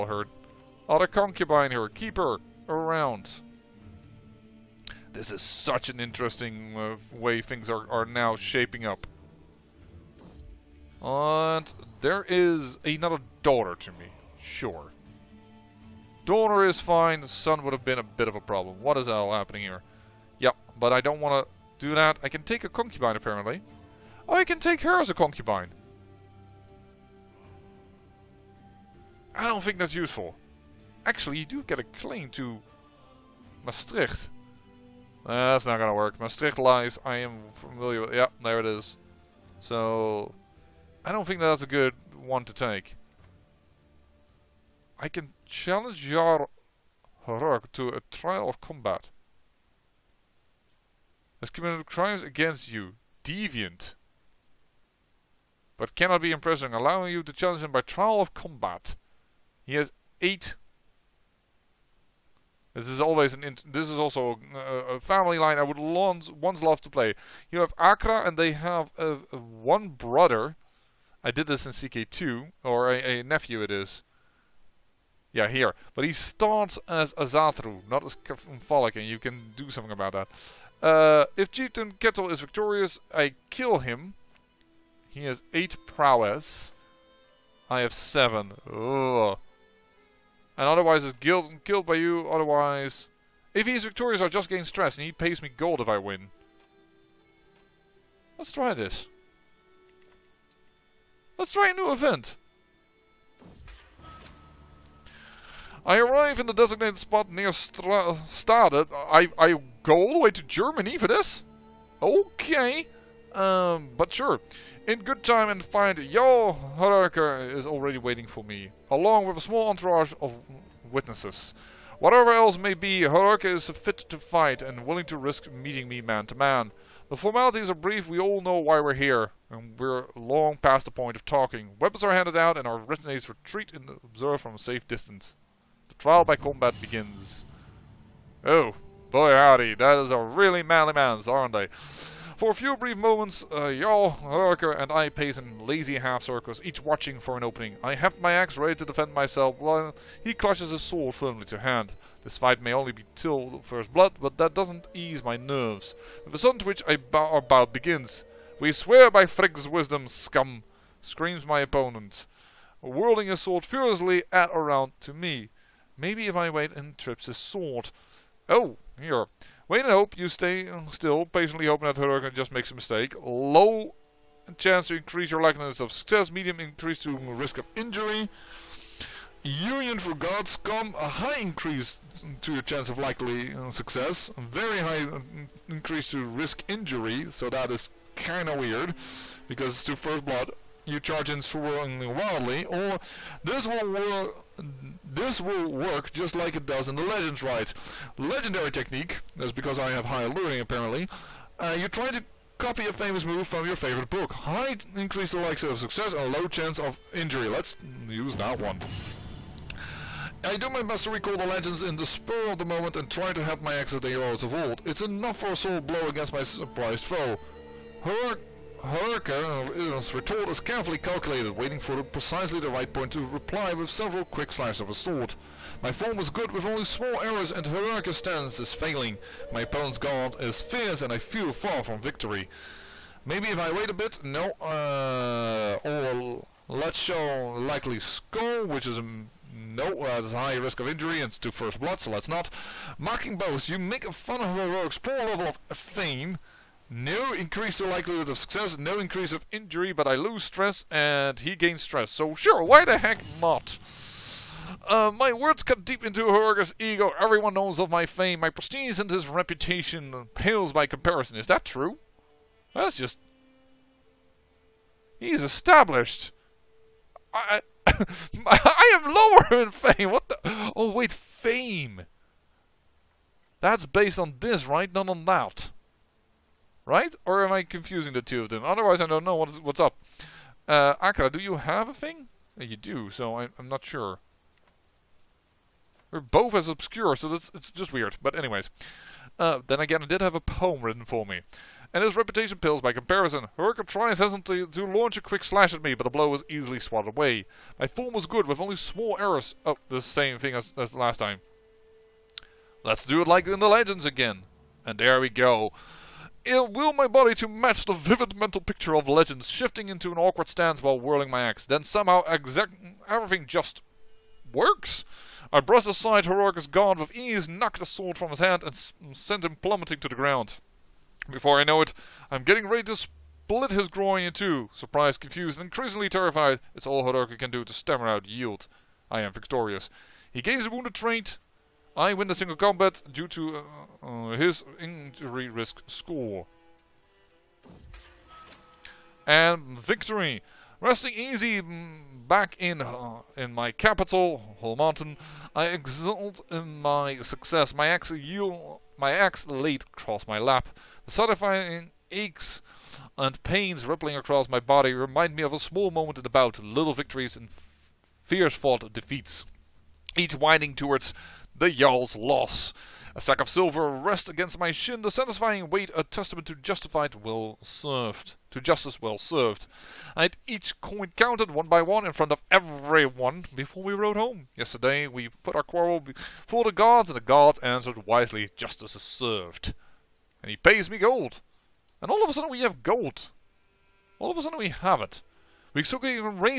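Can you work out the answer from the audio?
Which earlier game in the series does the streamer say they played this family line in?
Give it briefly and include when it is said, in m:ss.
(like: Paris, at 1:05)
CK2, at 1:11.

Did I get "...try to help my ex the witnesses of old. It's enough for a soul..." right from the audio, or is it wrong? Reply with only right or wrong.
wrong.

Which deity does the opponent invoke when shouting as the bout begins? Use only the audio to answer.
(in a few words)
Frigg.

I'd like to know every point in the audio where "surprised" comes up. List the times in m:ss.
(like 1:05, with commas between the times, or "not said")
3:36, 5:24.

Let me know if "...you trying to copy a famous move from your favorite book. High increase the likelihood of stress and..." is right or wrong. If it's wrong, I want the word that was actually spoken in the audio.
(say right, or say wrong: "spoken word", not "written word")
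wrong: "success", not "stress".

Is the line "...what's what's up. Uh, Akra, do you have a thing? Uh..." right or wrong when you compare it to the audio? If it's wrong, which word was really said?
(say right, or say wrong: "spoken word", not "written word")
right.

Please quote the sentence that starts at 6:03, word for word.
A sack of silver rests against my shin, the satisfying weight a testament to justified well served, to justice well served.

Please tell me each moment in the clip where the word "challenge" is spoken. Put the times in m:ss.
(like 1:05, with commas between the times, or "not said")
0:45, 0:57.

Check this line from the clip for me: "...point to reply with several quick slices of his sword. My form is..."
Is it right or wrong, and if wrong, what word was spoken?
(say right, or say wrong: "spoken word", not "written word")
right.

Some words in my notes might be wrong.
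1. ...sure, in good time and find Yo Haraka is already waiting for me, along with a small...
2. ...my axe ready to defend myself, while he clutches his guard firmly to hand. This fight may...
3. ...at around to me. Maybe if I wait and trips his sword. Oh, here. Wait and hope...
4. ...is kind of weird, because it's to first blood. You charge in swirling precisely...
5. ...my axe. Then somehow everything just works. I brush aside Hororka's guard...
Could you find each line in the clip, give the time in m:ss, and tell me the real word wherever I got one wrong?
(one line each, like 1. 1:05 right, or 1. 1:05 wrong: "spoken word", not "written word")
1. 1:54 right
2. 2:28 wrong: "sword", not "guard"
3. 2:44 right
4. 3:07 wrong: "wildly", not "precisely"
5. 5:11 right.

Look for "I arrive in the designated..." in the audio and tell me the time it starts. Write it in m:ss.
1:45.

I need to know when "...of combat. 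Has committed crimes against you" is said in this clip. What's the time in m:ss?
0:48.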